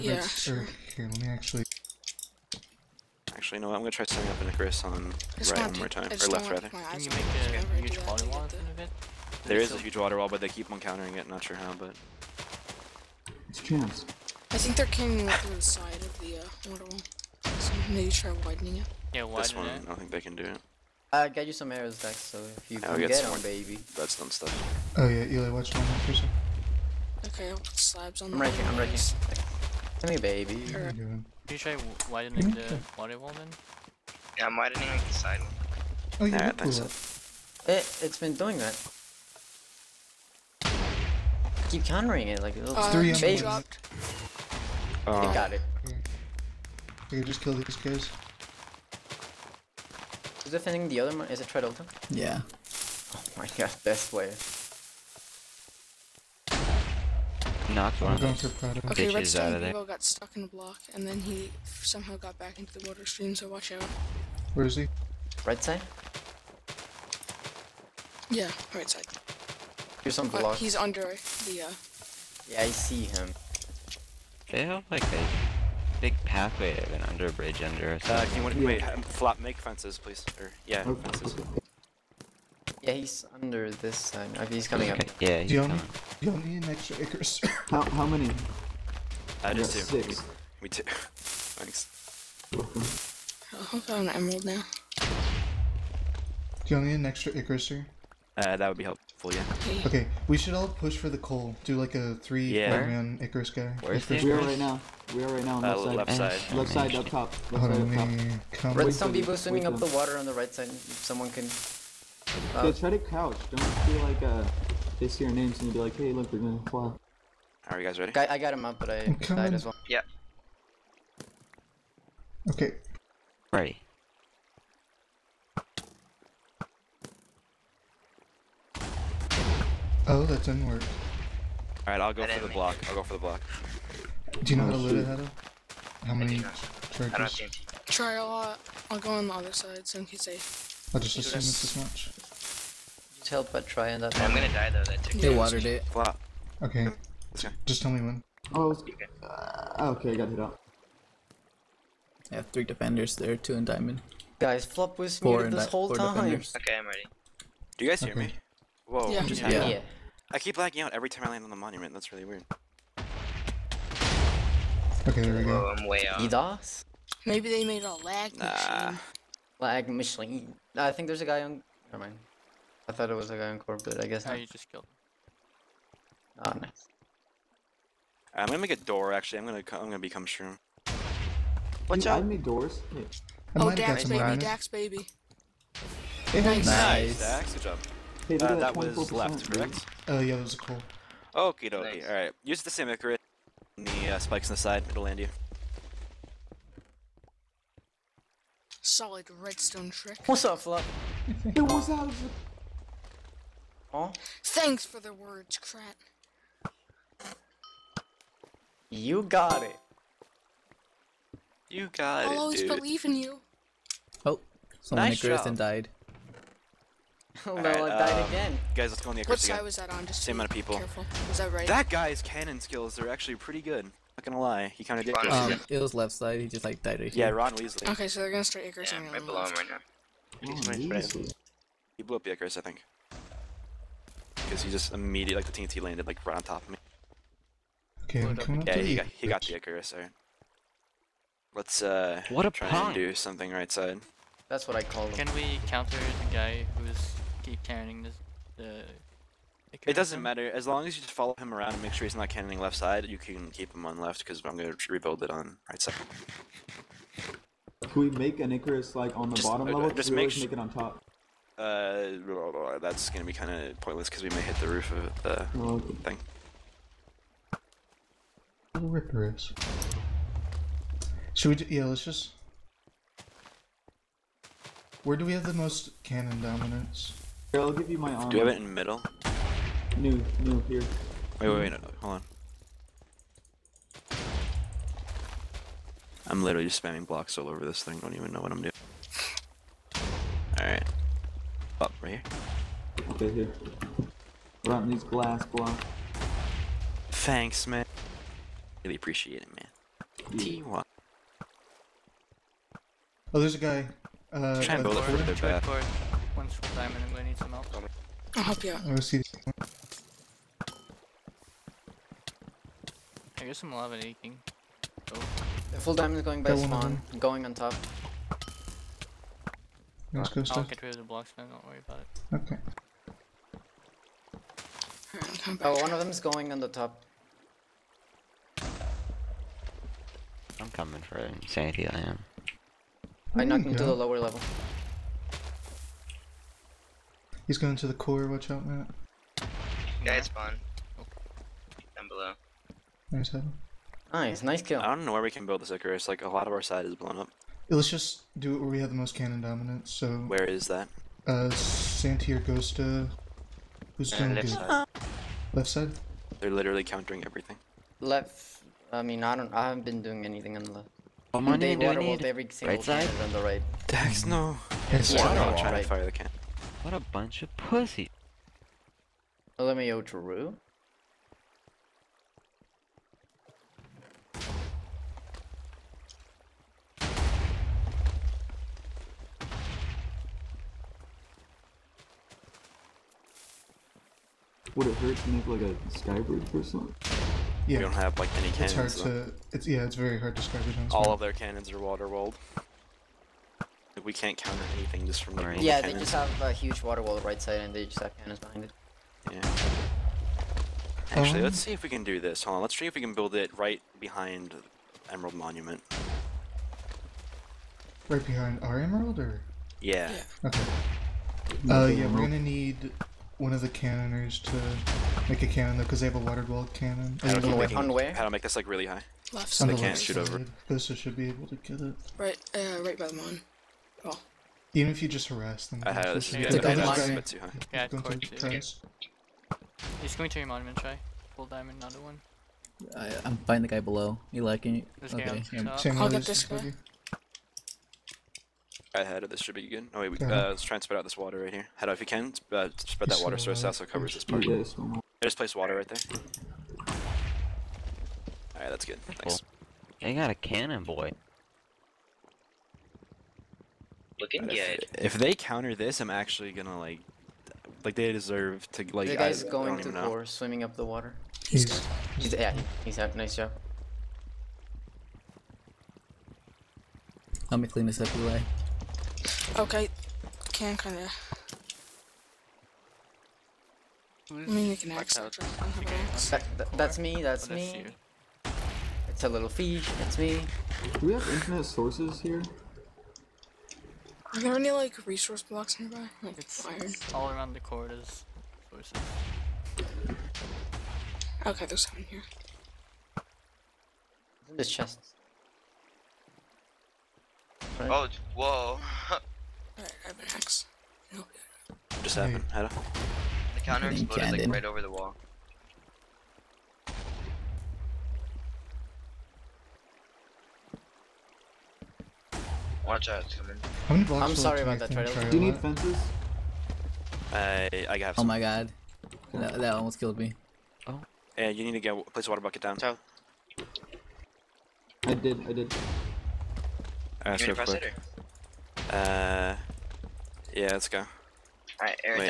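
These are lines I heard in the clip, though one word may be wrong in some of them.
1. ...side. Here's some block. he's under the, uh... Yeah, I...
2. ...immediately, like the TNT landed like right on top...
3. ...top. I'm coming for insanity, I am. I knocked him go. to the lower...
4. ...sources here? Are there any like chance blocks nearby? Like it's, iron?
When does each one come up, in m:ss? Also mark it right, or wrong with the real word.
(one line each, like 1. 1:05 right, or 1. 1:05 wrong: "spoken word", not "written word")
1. 1:08 right
2. 3:54 right
3. 5:26 right
4. 8:01 wrong: "resource", not "chance".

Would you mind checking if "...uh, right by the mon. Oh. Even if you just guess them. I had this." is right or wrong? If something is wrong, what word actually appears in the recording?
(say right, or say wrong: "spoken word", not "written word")
wrong: "harass", not "guess".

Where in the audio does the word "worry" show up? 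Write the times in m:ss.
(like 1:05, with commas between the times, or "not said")
5:21.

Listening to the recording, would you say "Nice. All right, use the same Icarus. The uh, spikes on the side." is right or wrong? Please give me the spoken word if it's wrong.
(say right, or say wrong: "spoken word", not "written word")
right.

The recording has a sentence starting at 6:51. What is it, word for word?
Uh, yeah, we're gonna need one of the cannoners to make a cannon though, because they have a water walled cannon.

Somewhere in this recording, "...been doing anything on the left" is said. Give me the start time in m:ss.
5:59.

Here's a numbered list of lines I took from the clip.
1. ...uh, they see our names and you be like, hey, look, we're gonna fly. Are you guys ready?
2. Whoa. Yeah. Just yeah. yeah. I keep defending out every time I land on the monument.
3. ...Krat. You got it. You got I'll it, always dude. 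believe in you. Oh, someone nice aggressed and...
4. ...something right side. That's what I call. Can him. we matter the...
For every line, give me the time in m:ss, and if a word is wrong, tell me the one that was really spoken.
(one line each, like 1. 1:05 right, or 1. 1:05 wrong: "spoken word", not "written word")
1. 1:54 right
2. 2:38 wrong: "lagging", not "defending"
3. 3:25 right
4. 4:03 wrong: "counter", not "matter".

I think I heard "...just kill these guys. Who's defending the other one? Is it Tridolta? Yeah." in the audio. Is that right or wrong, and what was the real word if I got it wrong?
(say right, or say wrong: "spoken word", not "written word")
right.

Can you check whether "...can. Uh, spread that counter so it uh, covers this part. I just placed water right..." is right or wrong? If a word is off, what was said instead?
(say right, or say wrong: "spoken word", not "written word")
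wrong: "water", not "counter".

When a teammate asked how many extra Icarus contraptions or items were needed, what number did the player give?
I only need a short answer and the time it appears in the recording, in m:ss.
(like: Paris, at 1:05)
6, at 1:30.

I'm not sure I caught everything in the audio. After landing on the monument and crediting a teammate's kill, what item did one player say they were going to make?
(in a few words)
A door.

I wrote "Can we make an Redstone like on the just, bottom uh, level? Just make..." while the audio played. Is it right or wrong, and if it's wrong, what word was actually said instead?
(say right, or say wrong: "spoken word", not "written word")
wrong: "Icarus", not "Redstone".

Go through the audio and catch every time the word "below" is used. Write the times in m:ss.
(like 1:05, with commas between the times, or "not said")
3:49, 7:13.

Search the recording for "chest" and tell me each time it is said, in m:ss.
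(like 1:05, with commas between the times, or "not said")
8:14.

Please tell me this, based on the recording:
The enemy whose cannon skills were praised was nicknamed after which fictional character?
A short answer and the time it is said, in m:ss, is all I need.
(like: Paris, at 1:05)
Ron Weasley, at 3:47.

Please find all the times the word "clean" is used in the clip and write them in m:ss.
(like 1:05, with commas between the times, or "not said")
7:47.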